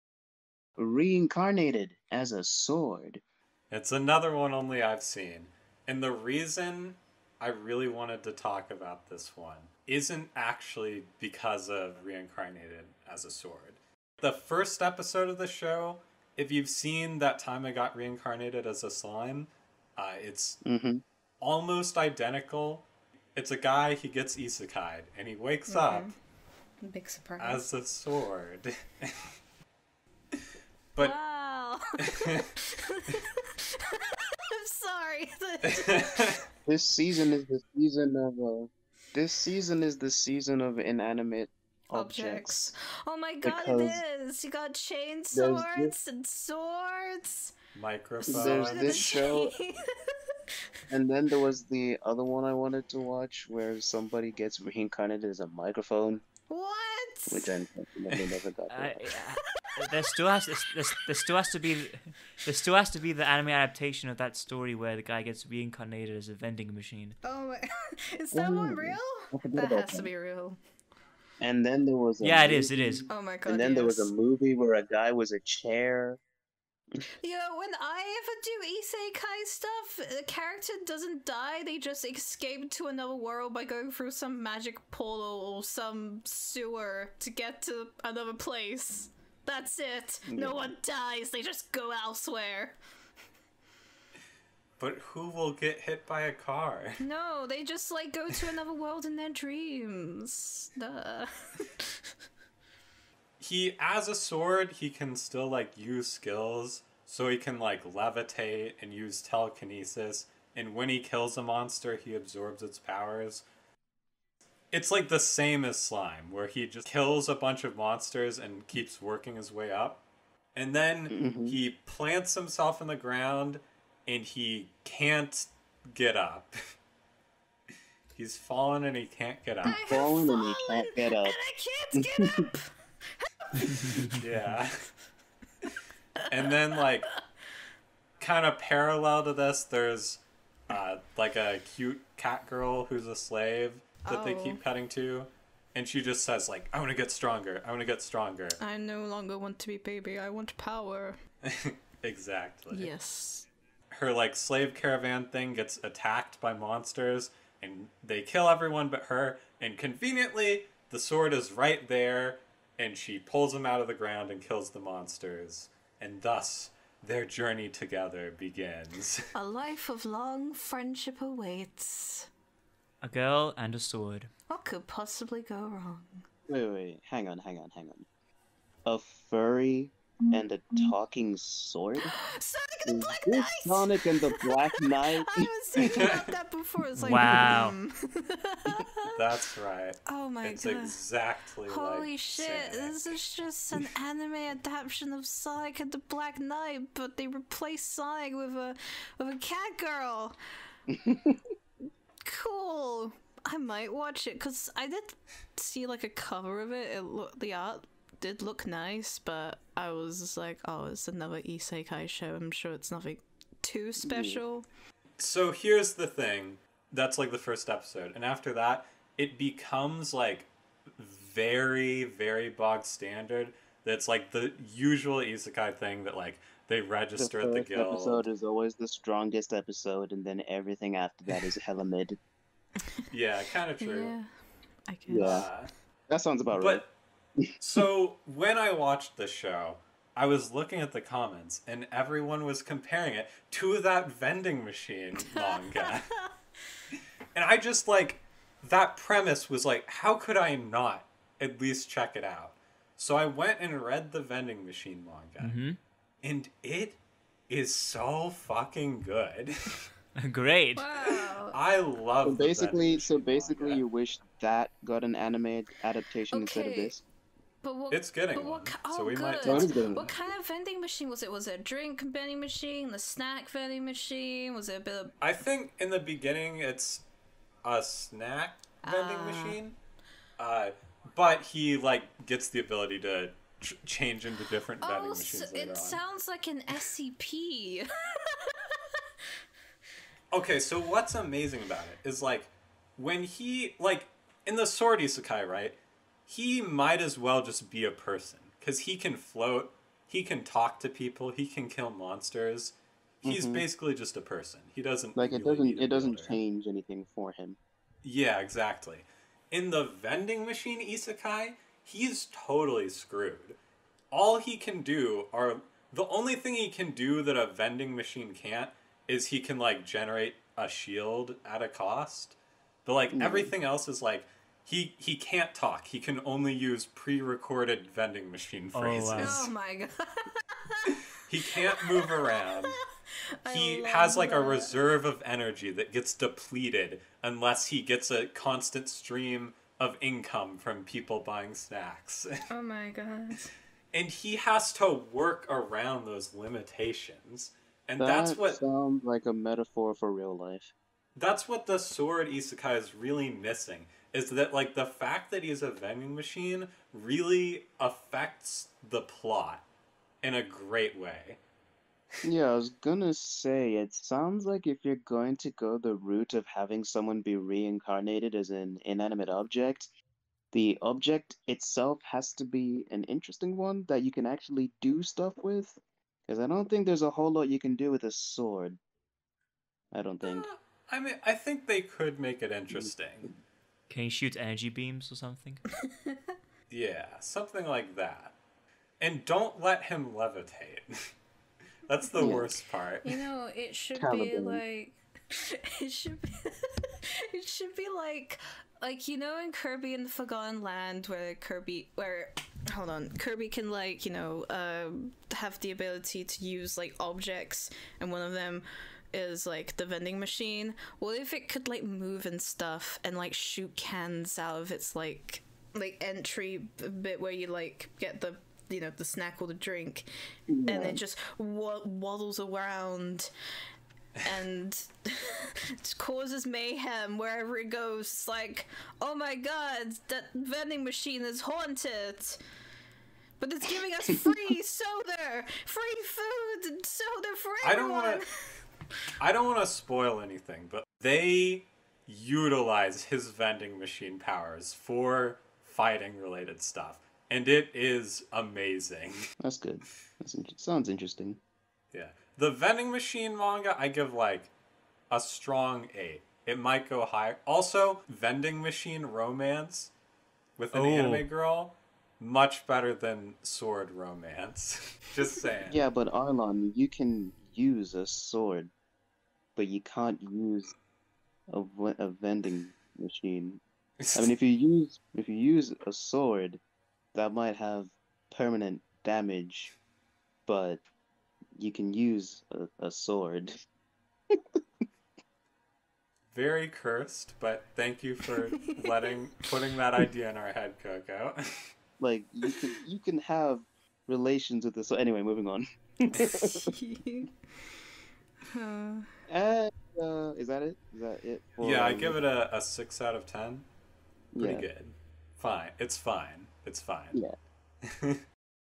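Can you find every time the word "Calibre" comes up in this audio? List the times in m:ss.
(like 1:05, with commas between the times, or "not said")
6:33.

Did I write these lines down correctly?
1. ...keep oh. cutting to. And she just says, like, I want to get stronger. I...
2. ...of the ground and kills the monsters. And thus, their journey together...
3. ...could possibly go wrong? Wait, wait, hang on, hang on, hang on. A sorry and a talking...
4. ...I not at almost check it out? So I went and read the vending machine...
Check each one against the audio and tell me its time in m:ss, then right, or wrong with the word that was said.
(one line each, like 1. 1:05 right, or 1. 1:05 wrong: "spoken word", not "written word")
1. 2:24 right
2. 2:43 right
3. 2:54 wrong: "furry", not "sorry"
4. 4:10 wrong: "least", not "almost".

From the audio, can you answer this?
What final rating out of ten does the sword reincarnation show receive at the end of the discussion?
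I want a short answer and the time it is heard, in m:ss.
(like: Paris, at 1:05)
6, at 8:22.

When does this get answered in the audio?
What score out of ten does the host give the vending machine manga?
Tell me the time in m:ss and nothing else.
7:35.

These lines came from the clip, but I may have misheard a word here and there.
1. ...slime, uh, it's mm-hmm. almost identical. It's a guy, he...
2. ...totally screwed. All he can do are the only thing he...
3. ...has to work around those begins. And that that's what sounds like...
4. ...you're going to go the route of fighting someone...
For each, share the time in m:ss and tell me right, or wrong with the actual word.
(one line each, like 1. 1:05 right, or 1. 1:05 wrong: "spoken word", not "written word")
1. 0:18 right
2. 5:12 right
3. 5:44 wrong: "limitations", not "begins"
4. 6:04 wrong: "having", not "fighting".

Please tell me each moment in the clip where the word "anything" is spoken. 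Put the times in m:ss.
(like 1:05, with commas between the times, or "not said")
5:06, 7:20.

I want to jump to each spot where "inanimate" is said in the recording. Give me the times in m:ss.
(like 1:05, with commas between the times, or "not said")
0:40, 6:08.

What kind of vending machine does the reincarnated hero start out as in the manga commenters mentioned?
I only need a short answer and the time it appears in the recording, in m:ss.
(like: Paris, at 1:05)
Snack vending machine, at 4:37.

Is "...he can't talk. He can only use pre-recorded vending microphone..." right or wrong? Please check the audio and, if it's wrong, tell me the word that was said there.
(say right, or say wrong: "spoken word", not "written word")
wrong: "machine", not "microphone".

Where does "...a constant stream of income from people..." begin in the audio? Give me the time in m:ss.
5:38.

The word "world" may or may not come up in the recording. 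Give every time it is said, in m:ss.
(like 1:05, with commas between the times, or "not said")
1:23, 1:38.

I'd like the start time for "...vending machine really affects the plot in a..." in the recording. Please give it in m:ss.
5:55.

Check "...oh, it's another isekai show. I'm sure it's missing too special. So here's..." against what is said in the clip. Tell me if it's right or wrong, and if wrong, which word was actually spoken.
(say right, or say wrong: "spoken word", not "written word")
wrong: "nothing", not "missing".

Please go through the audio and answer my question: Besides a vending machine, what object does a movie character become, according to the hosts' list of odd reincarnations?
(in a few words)
A chair.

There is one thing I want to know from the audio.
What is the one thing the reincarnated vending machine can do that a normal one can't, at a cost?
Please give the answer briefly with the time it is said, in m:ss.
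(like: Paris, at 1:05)
Generate a shield, at 5:19.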